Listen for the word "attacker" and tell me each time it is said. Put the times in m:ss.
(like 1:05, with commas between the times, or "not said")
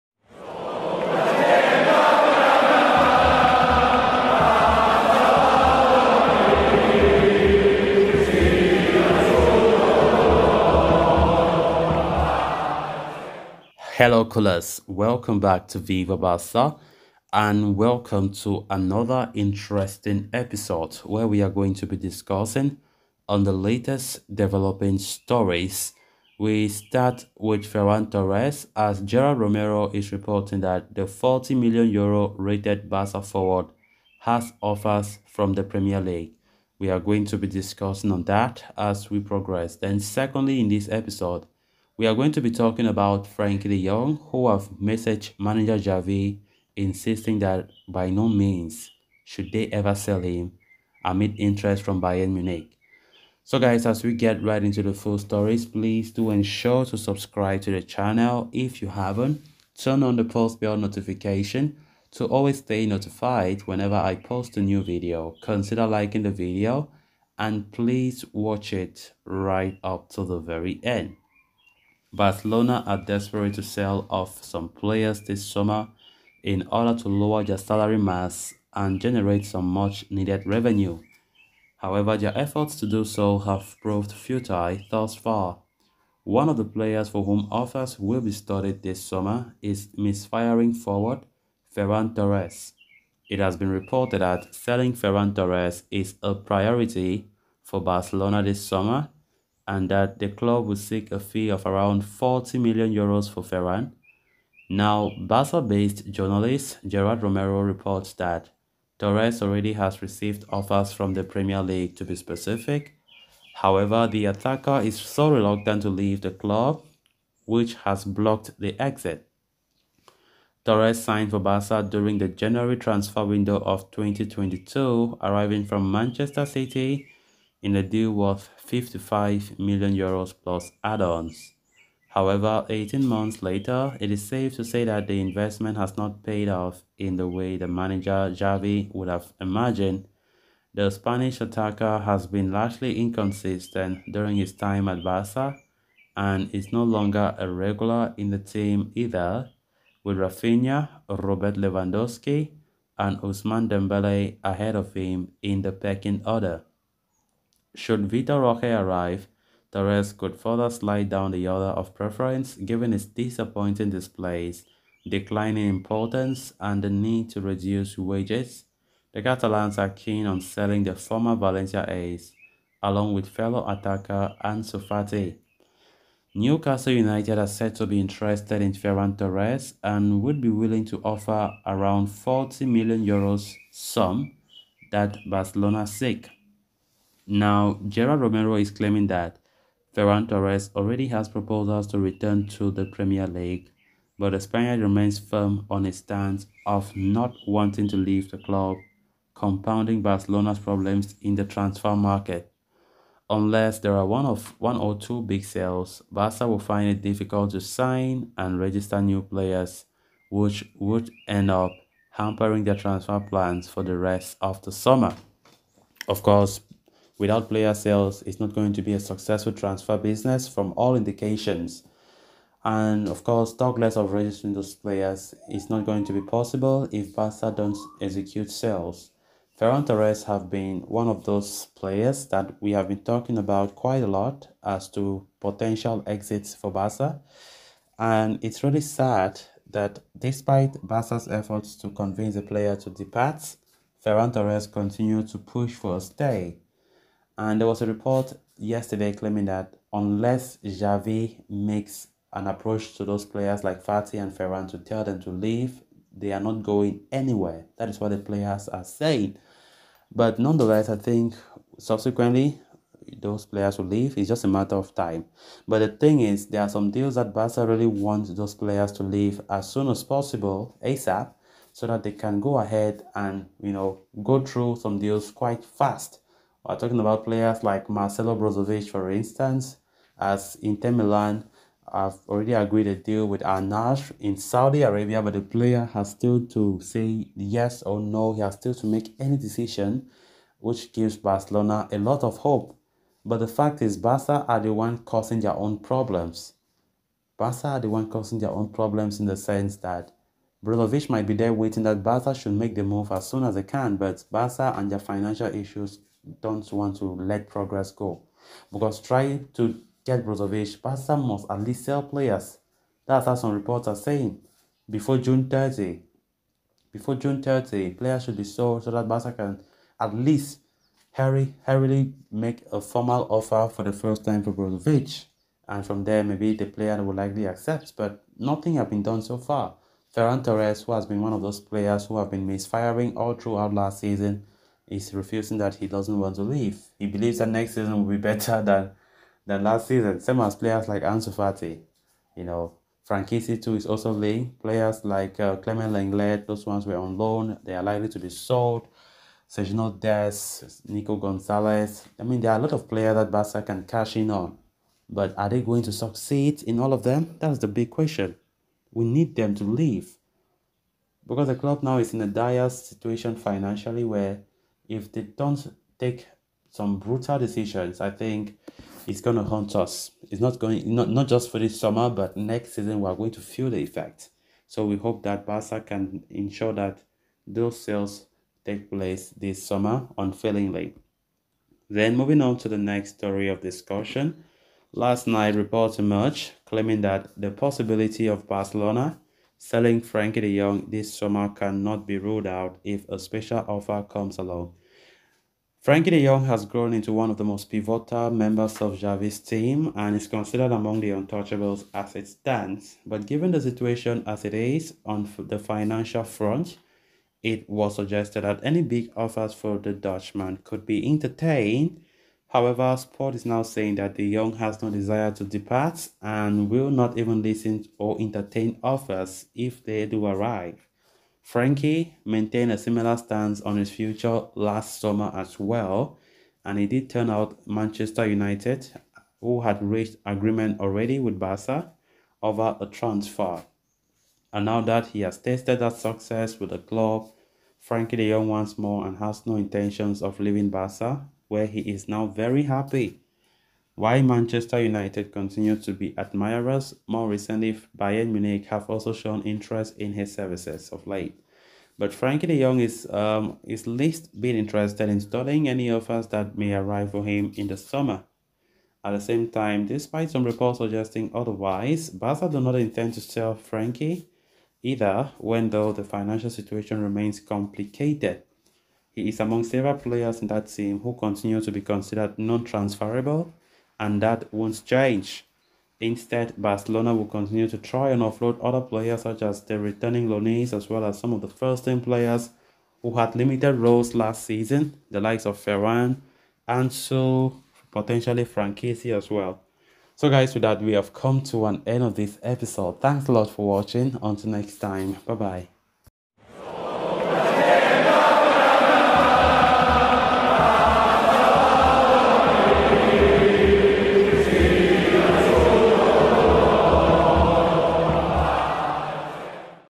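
1:54, 2:21, 2:53.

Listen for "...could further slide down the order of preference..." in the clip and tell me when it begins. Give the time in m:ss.
2:40.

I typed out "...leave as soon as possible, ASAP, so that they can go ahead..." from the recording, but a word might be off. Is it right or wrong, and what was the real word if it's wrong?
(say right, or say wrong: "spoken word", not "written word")
right.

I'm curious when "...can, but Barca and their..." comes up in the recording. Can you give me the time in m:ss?
5:03.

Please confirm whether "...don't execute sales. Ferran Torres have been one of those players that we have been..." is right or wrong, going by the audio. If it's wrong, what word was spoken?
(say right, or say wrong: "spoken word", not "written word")
right.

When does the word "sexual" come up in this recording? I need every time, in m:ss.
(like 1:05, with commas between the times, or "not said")
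not said.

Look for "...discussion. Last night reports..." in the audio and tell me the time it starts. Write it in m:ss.
6:23.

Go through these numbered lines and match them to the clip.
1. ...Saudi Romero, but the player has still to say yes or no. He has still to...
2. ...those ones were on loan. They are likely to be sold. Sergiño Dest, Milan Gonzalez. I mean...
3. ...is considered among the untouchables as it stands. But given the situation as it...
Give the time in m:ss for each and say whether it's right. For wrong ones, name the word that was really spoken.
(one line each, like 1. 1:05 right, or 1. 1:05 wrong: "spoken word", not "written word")
1. 4:44 wrong: "Arabia", not "Romero"
2. 5:46 wrong: "Nico", not "Milan"
3. 6:40 right.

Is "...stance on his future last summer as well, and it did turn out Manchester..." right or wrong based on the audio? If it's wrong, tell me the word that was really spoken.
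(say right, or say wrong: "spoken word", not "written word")
right.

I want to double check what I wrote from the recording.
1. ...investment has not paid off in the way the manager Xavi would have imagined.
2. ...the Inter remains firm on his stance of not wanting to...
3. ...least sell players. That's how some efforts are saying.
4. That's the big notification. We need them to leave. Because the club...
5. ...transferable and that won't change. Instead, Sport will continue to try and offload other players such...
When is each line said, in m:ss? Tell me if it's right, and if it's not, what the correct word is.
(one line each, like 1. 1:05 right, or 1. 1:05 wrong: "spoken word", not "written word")
1. 2:15 right
2. 3:14 wrong: "Spaniard", not "Inter"
3. 5:11 wrong: "reports", not "efforts"
4. 5:57 wrong: "question", not "notification"
5. 7:52 wrong: "Barcelona", not "Sport".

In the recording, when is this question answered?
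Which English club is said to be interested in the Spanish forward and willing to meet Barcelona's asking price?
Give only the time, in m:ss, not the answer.
2:56.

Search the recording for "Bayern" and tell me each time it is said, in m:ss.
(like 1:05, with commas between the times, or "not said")
0:52, 7:27.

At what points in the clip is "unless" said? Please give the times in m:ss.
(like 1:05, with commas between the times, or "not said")
3:23, 4:09.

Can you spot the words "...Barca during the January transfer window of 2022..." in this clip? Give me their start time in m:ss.
2:01.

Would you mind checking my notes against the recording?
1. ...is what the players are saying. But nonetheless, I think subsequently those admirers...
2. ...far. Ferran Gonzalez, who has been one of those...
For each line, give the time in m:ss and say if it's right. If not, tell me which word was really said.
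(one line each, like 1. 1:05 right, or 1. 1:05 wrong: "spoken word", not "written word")
1. 4:17 wrong: "players", not "admirers"
2. 5:29 wrong: "Torres", not "Gonzalez".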